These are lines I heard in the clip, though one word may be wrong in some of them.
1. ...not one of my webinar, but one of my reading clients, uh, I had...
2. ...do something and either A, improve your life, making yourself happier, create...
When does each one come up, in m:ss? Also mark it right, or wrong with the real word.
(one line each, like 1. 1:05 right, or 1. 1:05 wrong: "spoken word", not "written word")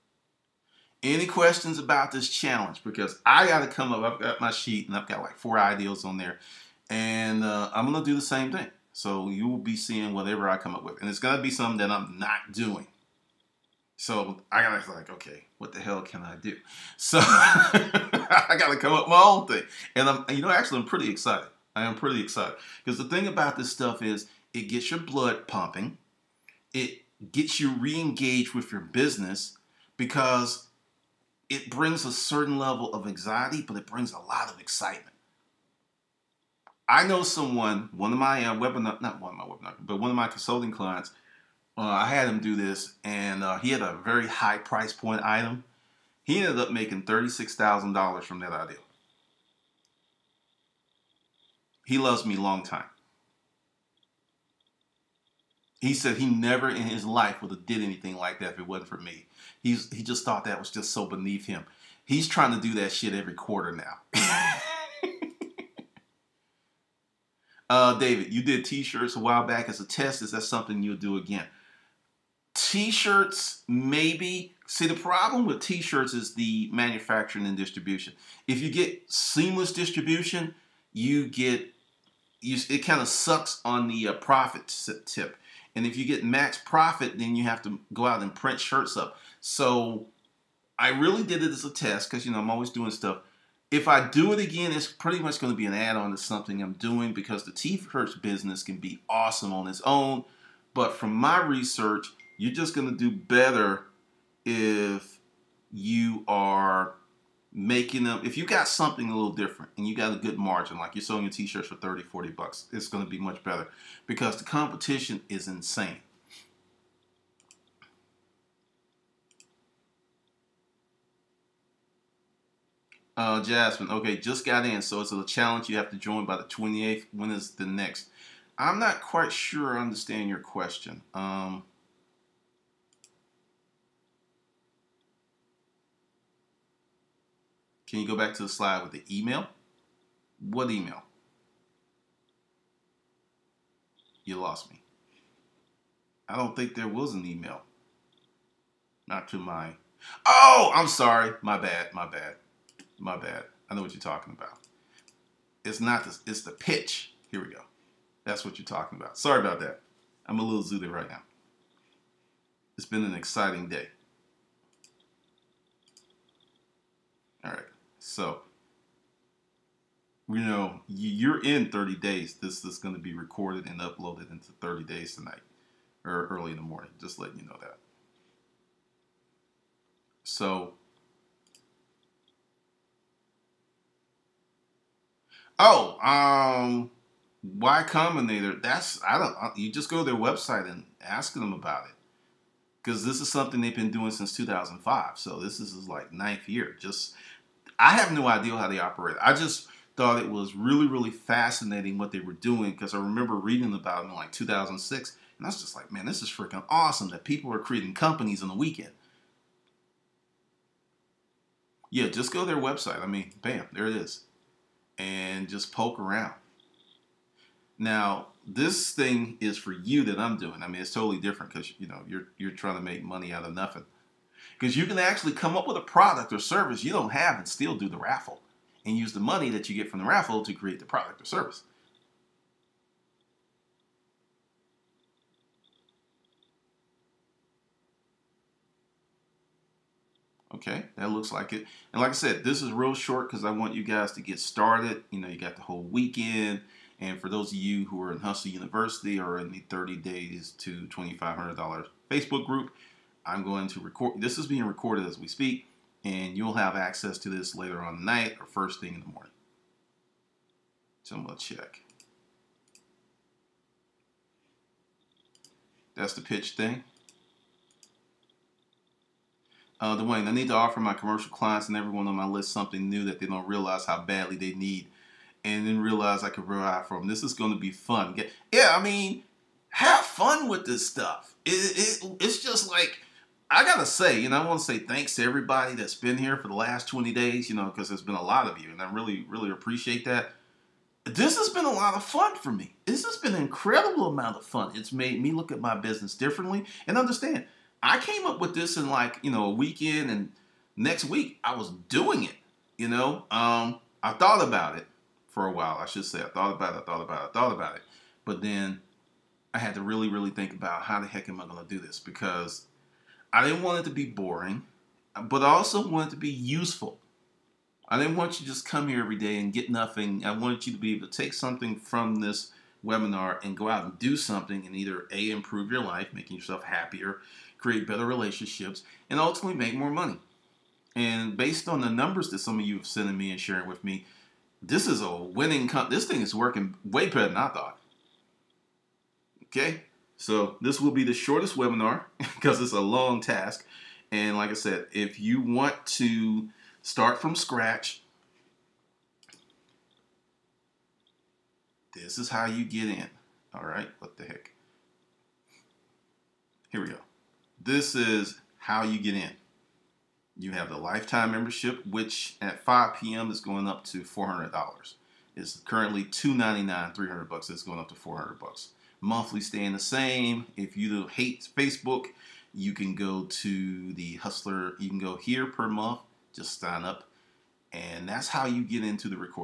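1. 0:39 wrong: "consulting", not "reading"
2. 5:23 right.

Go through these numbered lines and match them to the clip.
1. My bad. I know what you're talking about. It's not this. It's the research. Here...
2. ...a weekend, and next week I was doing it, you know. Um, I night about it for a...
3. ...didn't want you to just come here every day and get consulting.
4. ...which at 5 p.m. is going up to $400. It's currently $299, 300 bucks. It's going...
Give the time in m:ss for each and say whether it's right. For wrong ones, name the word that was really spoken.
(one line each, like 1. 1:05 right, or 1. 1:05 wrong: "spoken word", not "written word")
1. 2:32 wrong: "pitch", not "research"
2. 4:59 wrong: "thought", not "night"
3. 5:17 wrong: "nothing", not "consulting"
4. 6:01 right.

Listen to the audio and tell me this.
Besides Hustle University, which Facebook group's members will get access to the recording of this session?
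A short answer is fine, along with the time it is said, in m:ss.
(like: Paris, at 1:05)
30 days to $2,500, at 4:09.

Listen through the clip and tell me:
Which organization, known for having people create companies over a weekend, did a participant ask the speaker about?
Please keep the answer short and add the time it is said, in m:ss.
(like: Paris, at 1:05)
Y Combinator, at 3:07.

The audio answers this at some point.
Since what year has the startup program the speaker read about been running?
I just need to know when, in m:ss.
3:14.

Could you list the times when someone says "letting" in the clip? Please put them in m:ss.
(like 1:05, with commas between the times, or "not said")
2:57.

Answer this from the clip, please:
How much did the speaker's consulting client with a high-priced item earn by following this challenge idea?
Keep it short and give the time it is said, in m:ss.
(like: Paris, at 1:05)
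$36,000, at 0:47.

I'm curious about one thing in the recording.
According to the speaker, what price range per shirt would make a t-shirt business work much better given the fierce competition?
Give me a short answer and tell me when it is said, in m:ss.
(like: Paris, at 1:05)
30 40 bucks, at 1:51.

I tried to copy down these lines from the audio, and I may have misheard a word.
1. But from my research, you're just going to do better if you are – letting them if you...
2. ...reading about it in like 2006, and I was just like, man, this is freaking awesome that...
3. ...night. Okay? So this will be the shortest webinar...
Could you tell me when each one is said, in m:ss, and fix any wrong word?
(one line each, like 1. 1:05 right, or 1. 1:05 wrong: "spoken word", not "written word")
1. 1:40 wrong: "making", not "letting"
2. 3:23 right
3. 5:37 wrong: "thought", not "night".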